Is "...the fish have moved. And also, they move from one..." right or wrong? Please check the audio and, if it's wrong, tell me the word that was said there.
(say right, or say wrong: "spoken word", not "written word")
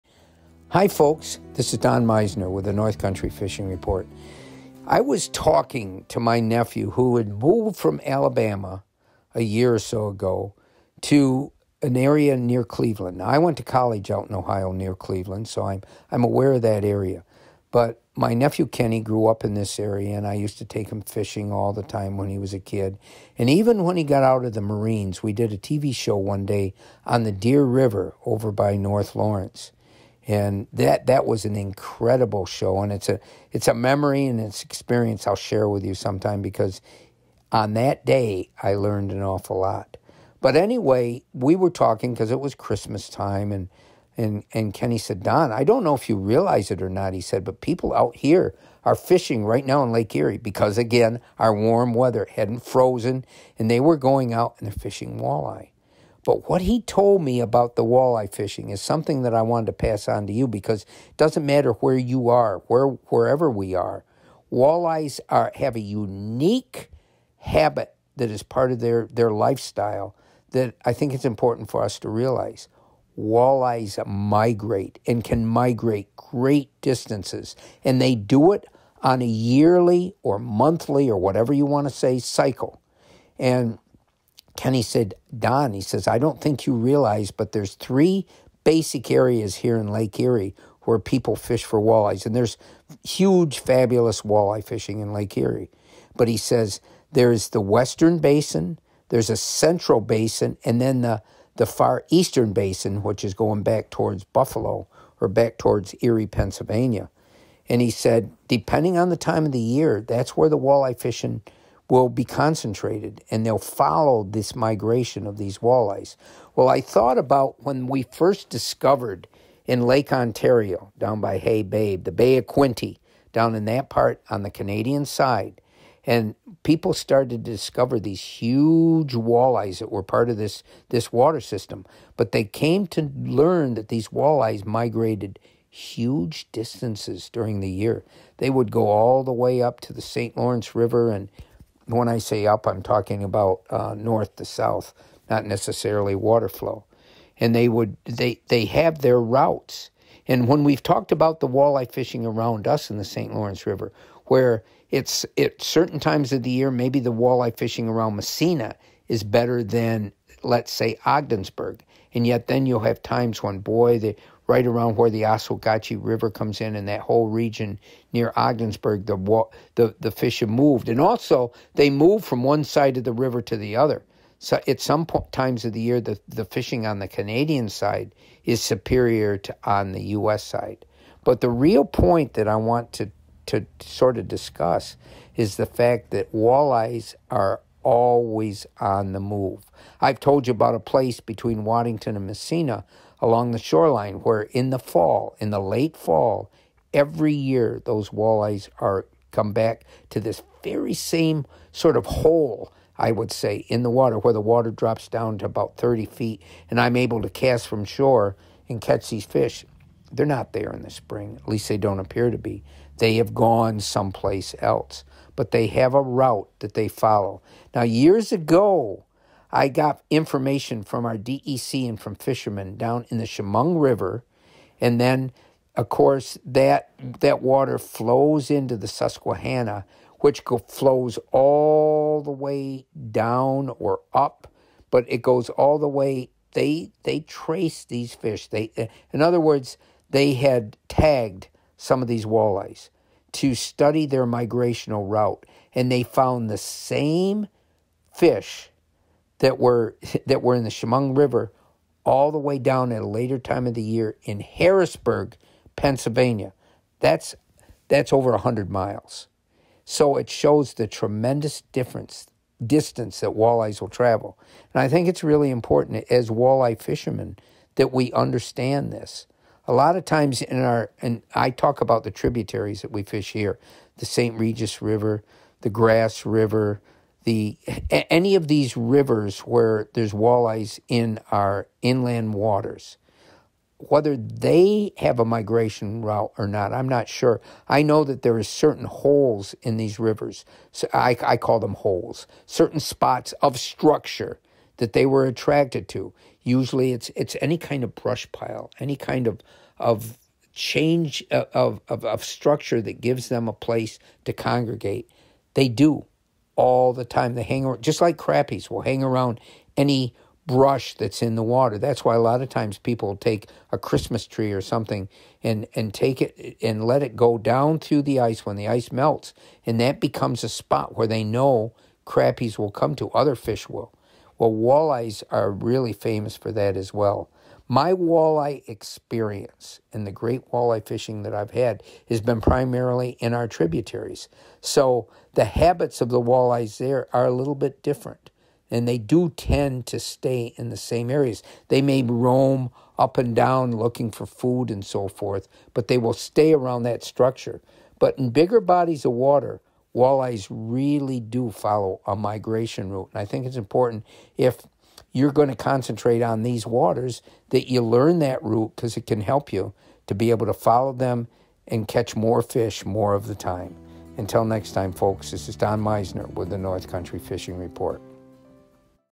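right.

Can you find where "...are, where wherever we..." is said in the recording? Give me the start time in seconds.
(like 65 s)
62 s.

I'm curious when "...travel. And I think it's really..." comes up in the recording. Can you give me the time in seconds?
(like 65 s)
263 s.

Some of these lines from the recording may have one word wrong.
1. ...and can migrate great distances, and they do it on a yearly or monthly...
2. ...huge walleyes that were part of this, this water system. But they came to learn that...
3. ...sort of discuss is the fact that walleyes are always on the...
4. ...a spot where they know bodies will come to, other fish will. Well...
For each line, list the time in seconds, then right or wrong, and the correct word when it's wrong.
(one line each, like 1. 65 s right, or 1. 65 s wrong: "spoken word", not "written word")
1. 75 s right
2. 128 s right
3. 183 s right
4. 320 s wrong: "crappies", not "bodies".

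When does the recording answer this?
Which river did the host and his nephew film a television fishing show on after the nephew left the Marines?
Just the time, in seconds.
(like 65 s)
27 s.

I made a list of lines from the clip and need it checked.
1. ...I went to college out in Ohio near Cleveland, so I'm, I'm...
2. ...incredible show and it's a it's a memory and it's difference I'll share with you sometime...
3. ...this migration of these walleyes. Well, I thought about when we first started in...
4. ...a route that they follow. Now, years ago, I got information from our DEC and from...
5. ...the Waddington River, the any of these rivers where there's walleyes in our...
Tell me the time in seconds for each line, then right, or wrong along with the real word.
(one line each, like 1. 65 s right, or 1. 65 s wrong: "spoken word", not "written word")
1. 13 s right
2. 31 s wrong: "experience", not "difference"
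3. 114 s wrong: "discovered", not "started"
4. 215 s right
5. 275 s wrong: "Grass", not "Waddington".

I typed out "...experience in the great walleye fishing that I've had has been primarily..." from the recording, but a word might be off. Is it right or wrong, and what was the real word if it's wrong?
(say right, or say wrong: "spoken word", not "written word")
right.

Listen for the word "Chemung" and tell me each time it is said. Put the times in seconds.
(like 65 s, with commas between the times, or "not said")
223 s, 250 s.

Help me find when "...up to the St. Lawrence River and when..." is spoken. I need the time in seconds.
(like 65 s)
139 s.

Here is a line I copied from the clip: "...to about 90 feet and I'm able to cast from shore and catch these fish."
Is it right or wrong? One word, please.
wrong.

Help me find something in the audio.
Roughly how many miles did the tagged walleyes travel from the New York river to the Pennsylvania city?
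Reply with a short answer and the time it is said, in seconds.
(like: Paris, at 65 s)
over 100 miles, at 258 s.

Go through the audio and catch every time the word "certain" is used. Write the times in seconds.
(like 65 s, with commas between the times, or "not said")
155 s, 288 s, 292 s.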